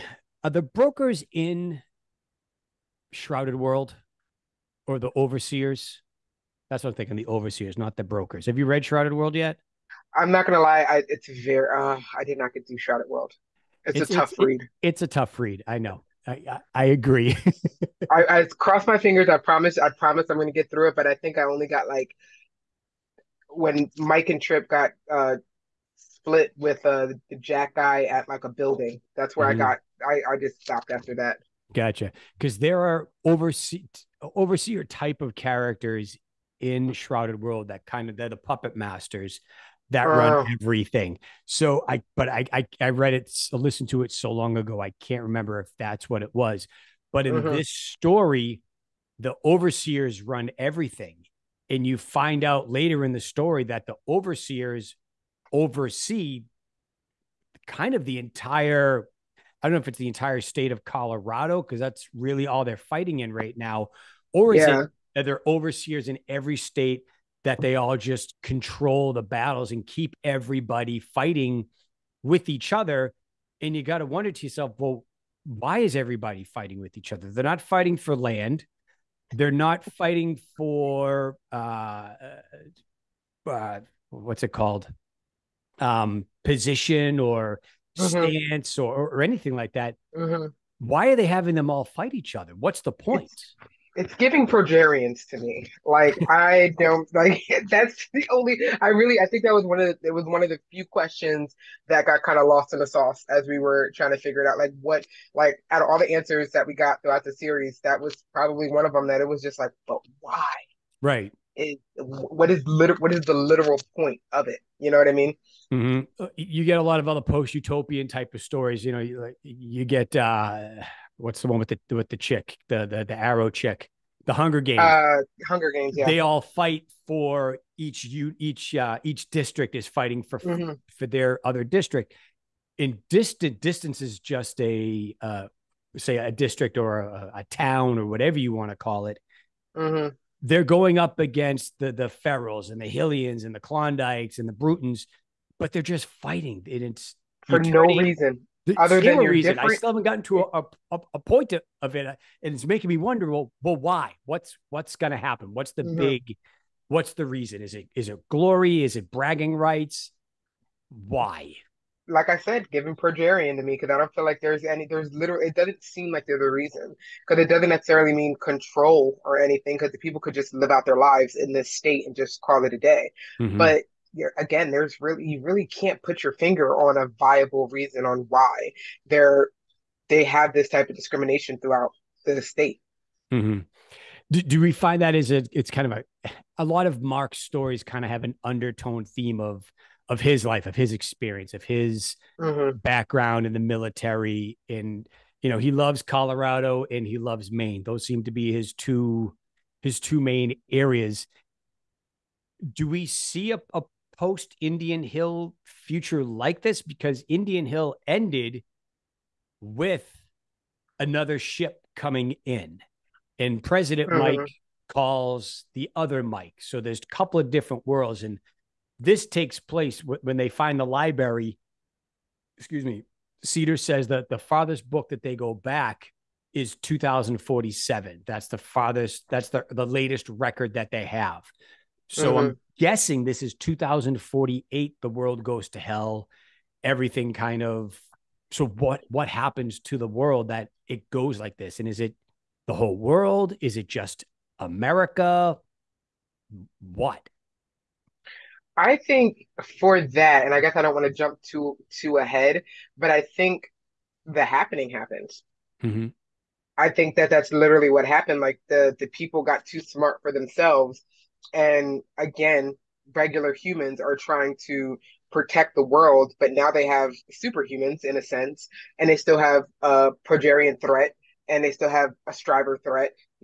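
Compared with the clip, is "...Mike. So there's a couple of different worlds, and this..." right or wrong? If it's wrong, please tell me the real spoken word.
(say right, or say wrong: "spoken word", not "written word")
right.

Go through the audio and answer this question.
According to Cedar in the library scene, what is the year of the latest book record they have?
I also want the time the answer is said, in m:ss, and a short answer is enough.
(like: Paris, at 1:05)
2047, at 3:46.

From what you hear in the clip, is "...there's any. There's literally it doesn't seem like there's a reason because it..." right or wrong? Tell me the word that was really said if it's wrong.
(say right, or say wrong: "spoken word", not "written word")
right.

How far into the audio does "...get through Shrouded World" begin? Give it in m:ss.
0:12.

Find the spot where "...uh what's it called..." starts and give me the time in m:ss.
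1:23.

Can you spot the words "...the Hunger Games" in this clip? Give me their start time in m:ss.
2:04.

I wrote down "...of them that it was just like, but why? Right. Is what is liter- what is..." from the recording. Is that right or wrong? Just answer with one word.
right.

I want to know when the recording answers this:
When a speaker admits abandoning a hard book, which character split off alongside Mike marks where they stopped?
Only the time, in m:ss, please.
0:24.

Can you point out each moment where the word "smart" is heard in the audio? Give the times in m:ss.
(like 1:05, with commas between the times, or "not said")
4:19.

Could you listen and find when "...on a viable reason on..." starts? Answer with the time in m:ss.
2:56.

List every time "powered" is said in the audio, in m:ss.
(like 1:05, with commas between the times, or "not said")
not said.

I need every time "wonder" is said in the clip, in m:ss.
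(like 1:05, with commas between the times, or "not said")
1:14, 2:32.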